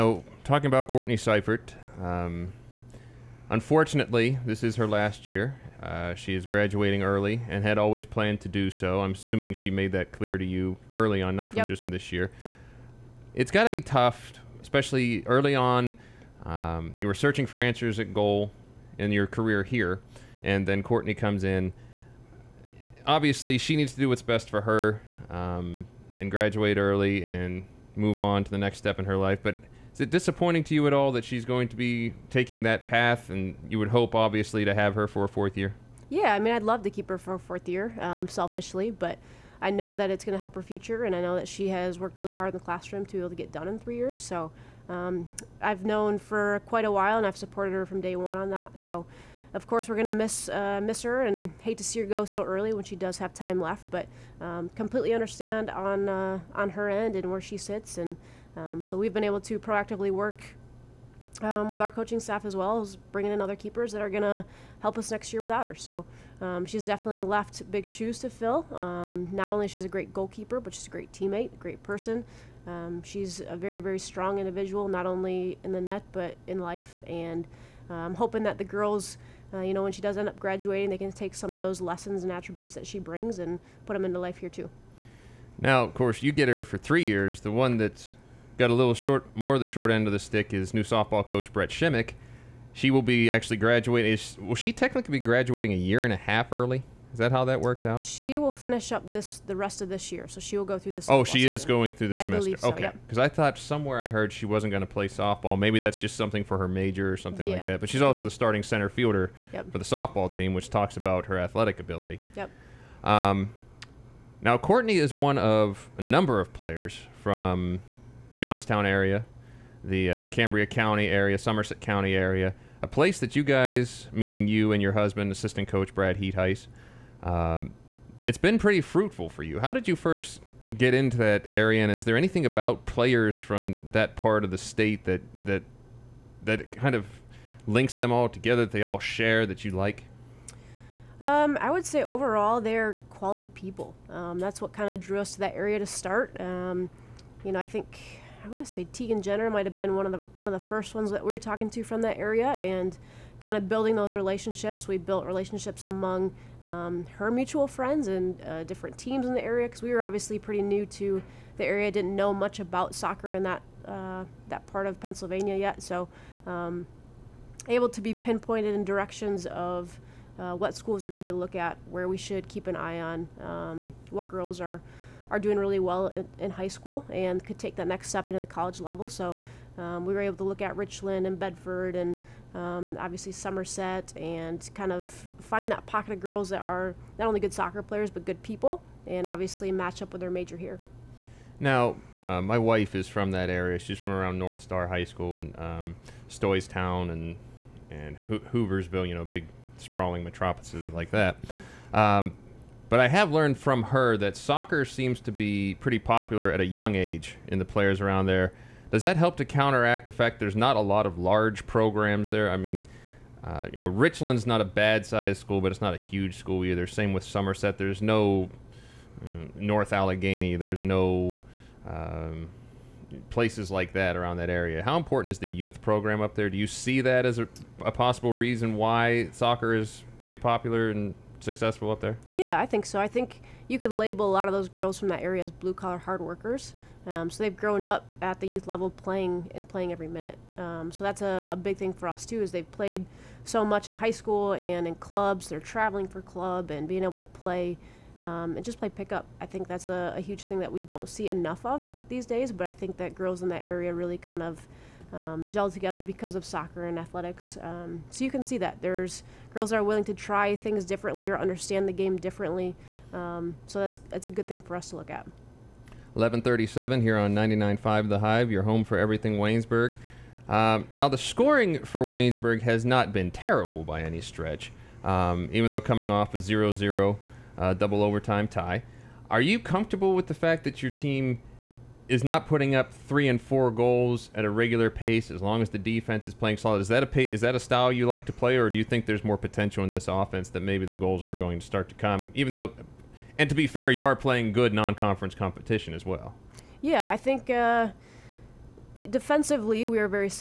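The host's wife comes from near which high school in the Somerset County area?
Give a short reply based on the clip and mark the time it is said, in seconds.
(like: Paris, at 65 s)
North Star High School, at 194 s.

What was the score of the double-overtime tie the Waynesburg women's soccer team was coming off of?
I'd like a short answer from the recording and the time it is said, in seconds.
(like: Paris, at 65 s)
0-0, at 276 s.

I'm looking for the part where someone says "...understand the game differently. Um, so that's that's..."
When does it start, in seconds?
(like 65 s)
261 s.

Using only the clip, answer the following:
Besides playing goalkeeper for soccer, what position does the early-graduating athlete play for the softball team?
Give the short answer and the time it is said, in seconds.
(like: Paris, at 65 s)
Center fielder, at 108 s.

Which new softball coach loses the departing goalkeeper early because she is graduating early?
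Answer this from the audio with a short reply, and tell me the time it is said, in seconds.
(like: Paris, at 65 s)
Brett Shimmick, at 91 s.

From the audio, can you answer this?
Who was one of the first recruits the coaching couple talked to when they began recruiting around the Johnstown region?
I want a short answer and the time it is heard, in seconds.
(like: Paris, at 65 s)
Tegan Jenner, at 148 s.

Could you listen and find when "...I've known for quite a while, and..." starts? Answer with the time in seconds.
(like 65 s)
45 s.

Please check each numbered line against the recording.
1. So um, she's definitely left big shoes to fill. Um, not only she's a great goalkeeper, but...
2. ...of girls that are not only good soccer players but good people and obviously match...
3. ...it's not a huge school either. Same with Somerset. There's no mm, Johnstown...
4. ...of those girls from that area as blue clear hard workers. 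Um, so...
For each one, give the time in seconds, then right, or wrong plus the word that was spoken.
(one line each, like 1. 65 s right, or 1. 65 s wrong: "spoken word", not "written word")
1. 65 s right
2. 186 s right
3. 215 s wrong: "North", not "Johnstown"
4. 234 s wrong: "collar", not "clear".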